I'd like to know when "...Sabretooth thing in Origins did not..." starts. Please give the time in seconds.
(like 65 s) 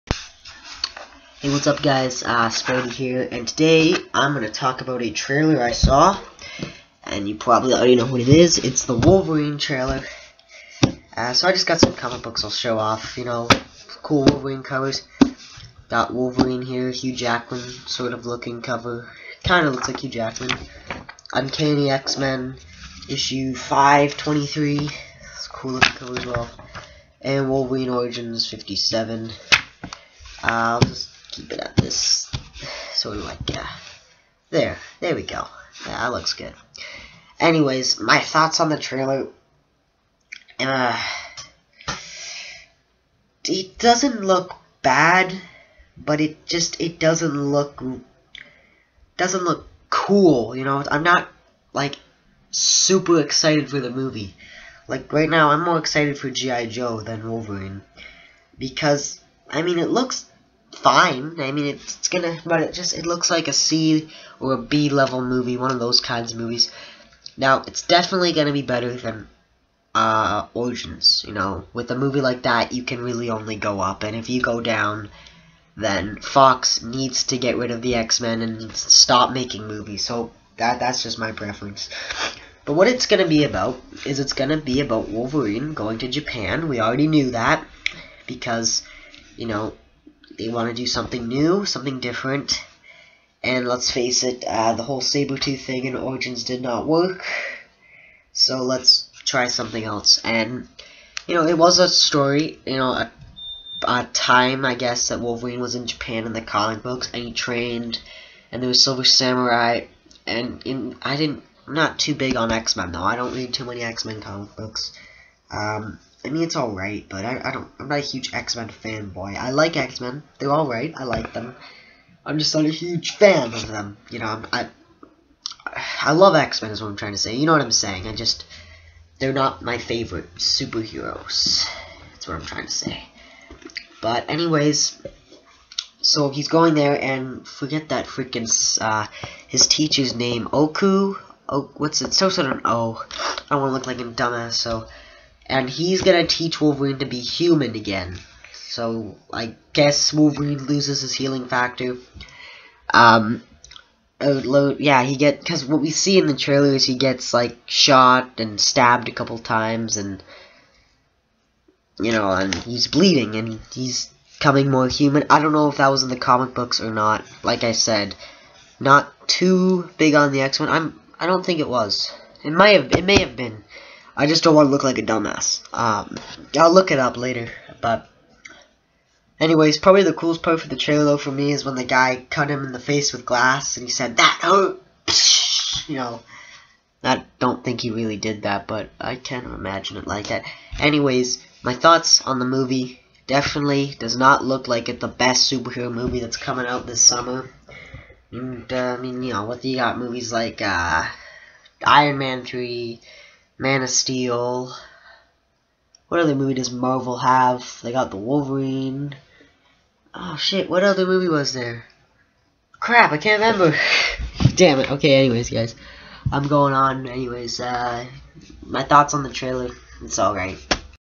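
95 s.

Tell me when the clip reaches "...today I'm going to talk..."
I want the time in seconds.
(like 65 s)
3 s.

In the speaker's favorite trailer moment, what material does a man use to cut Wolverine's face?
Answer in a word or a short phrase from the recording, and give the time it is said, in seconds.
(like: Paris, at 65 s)
Glass, at 183 s.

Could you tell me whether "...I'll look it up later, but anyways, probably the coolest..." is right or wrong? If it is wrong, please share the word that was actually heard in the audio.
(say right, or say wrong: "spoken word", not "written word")
right.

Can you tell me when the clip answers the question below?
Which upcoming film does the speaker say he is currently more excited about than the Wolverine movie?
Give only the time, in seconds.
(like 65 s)
56 s.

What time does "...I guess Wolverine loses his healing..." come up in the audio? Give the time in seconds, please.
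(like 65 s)
149 s.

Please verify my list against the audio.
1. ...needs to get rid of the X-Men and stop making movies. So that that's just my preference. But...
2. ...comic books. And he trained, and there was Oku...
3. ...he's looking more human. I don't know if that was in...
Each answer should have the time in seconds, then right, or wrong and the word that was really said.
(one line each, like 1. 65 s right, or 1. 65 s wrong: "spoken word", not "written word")
1. 76 s right
2. 106 s wrong: "Silver", not "Oku"
3. 163 s wrong: "coming", not "looking".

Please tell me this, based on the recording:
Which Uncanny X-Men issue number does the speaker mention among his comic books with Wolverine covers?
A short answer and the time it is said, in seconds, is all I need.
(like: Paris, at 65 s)
523, at 23 s.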